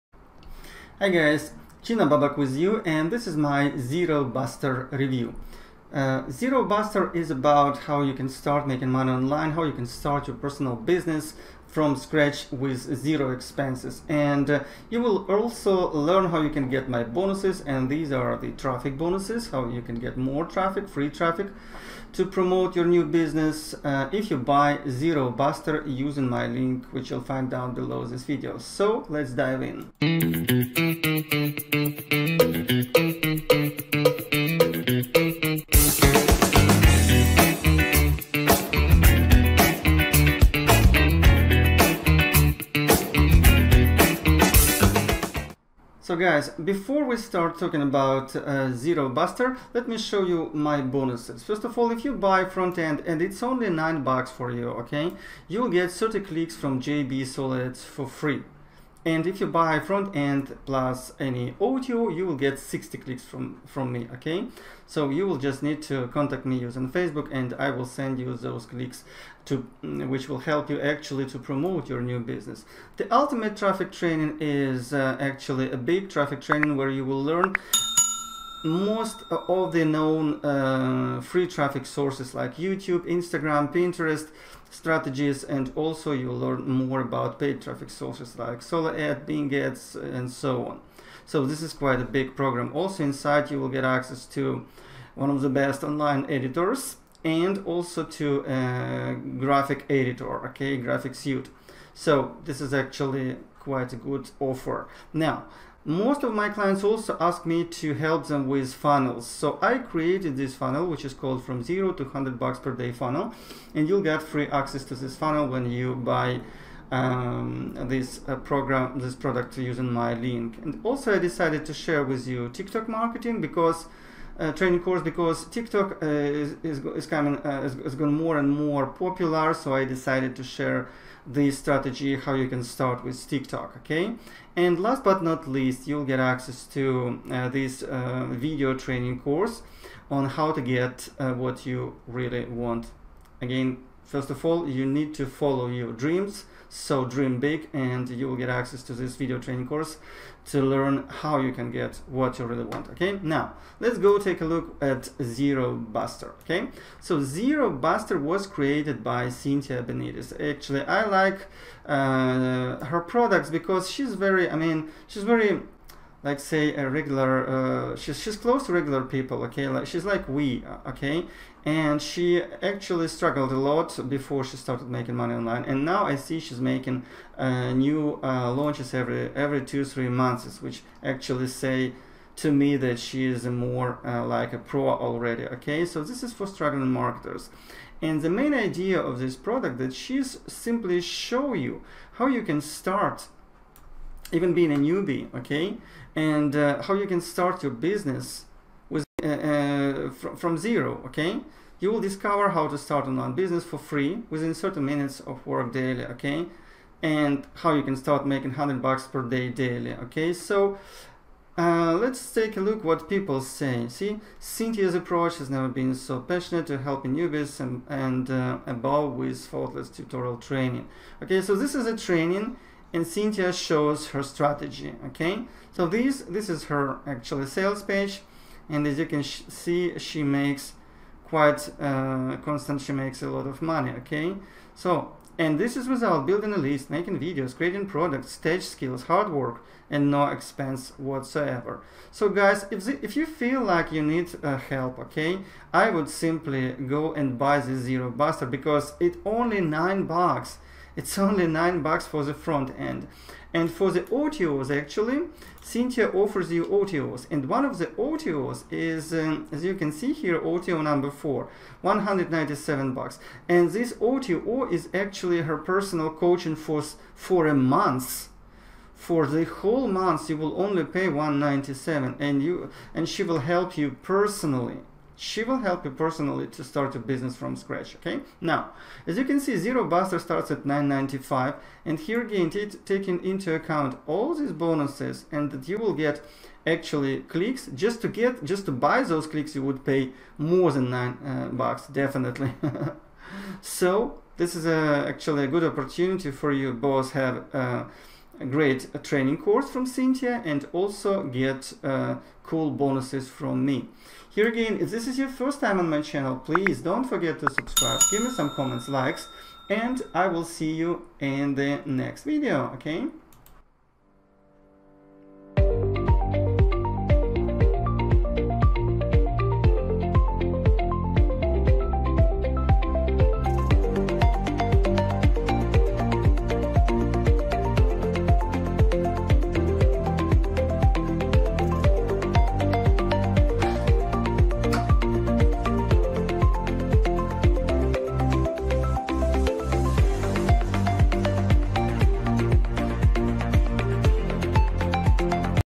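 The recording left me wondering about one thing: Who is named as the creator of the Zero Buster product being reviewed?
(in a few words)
Cynthia Benitez.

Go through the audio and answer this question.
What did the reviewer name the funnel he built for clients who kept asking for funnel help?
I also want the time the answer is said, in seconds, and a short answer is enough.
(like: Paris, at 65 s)
from zero to 100 bucks per day, at 111 s.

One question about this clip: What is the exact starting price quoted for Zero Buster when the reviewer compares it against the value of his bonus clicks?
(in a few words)
9.95.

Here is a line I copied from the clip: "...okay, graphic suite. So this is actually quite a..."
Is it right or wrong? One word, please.
right.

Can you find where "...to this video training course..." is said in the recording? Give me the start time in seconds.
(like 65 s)
148 s.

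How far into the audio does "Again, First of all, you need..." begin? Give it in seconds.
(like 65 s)
143 s.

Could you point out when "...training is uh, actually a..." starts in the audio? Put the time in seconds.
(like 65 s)
73 s.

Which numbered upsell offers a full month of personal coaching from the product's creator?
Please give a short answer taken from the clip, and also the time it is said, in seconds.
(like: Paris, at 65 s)
OTO number 4, at 260 s.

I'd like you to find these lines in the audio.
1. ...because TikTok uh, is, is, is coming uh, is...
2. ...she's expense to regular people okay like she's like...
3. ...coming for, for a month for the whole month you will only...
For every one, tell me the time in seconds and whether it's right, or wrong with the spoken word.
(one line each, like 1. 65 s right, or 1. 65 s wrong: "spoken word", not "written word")
1. 125 s right
2. 168 s wrong: "close", not "expense"
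3. 266 s wrong: "coaching", not "coming".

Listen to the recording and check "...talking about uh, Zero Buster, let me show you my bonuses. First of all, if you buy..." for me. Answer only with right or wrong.
right.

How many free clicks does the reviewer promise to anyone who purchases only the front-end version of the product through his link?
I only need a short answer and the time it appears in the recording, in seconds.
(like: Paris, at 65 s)
30, at 55 s.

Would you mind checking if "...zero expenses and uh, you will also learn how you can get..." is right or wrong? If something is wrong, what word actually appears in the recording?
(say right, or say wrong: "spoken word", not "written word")
right.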